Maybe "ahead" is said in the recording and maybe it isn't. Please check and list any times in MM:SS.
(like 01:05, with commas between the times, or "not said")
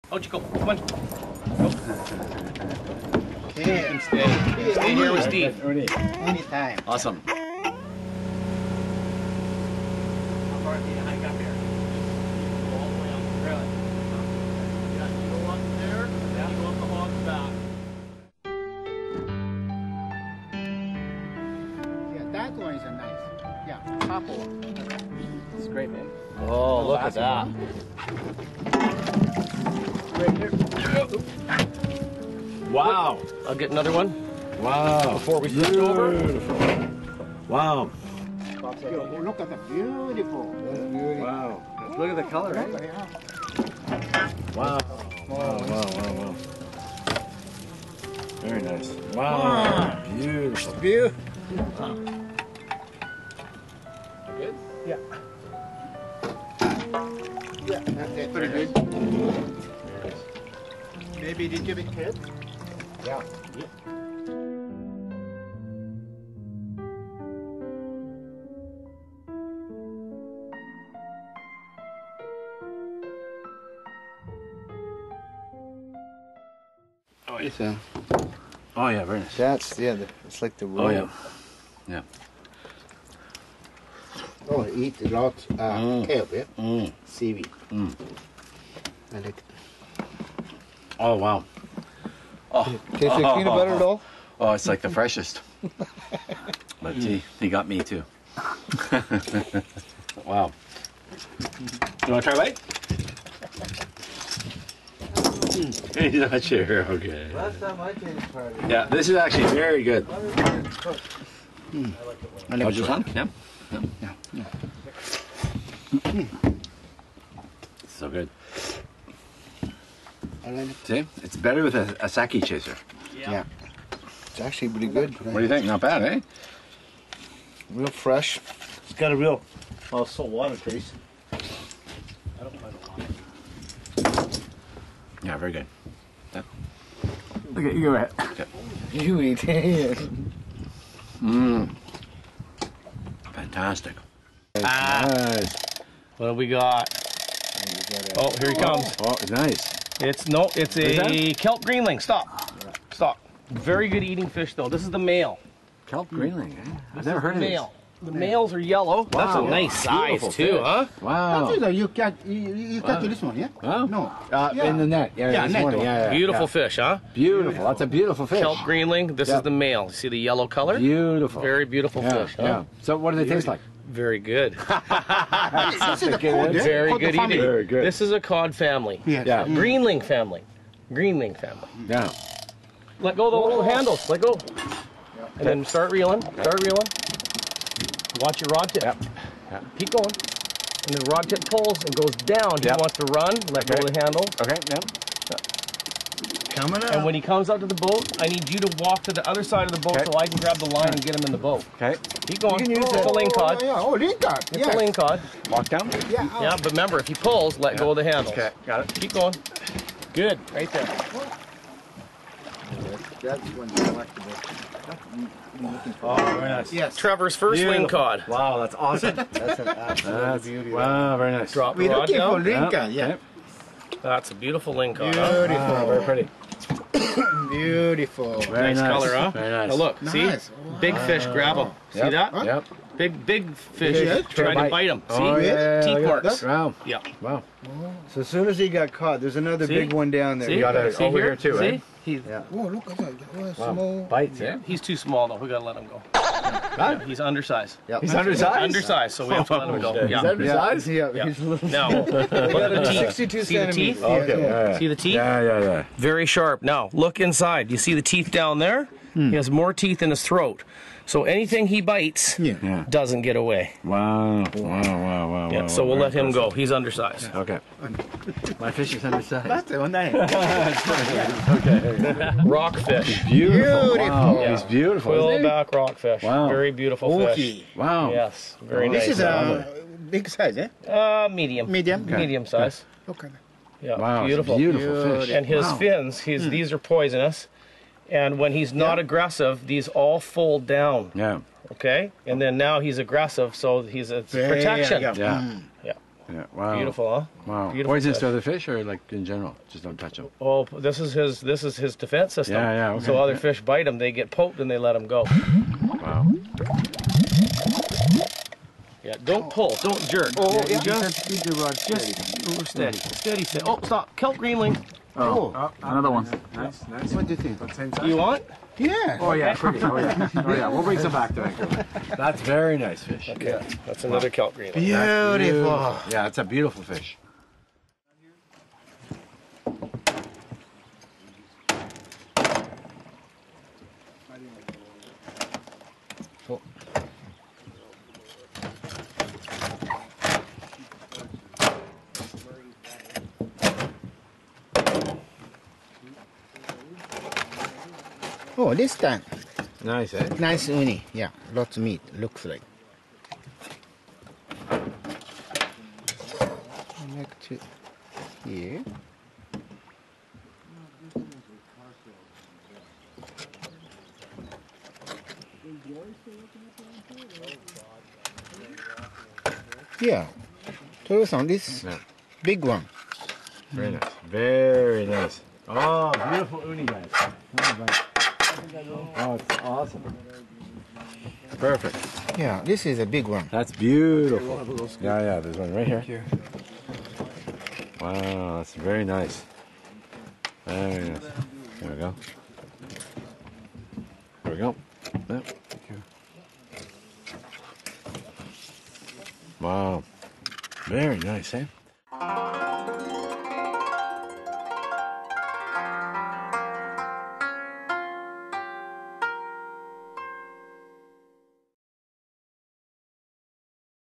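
02:17.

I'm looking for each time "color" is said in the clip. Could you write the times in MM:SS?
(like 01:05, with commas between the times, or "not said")
00:42, 02:50, 03:48.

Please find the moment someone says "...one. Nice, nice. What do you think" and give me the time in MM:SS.
05:16.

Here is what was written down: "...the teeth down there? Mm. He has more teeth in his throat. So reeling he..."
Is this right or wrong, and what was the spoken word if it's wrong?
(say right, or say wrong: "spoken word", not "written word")
wrong: "anything", not "reeling".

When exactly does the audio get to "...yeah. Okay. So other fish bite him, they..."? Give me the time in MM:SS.
05:02.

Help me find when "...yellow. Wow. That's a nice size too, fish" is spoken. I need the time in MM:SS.
02:38.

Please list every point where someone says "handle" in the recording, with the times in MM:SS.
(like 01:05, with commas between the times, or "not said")
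03:03, 03:14, 03:28.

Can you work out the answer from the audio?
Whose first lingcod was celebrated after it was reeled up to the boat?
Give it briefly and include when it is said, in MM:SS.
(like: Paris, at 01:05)
Trevor, at 03:36.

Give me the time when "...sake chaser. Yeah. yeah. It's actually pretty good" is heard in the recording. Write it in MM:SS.
02:02.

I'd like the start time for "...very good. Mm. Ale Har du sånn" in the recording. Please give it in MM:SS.
01:49.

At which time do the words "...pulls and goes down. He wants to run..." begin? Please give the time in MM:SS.
03:11.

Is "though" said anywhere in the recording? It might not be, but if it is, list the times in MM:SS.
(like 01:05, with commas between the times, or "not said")
02:34, 04:05.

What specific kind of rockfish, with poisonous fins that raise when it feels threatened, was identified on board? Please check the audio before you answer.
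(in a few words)
Quillback rockfish.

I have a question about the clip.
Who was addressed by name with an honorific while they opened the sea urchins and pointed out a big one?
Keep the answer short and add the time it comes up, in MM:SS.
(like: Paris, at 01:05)
Tojo-san, at 06:11.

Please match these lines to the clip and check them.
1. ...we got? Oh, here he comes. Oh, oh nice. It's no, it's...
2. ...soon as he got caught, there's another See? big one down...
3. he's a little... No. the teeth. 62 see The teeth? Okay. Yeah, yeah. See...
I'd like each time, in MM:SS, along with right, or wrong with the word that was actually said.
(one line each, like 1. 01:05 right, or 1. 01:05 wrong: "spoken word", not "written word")
1. 02:26 right
2. 03:58 right
3. 04:11 right.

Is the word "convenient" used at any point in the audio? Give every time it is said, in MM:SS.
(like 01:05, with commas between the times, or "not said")
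not said.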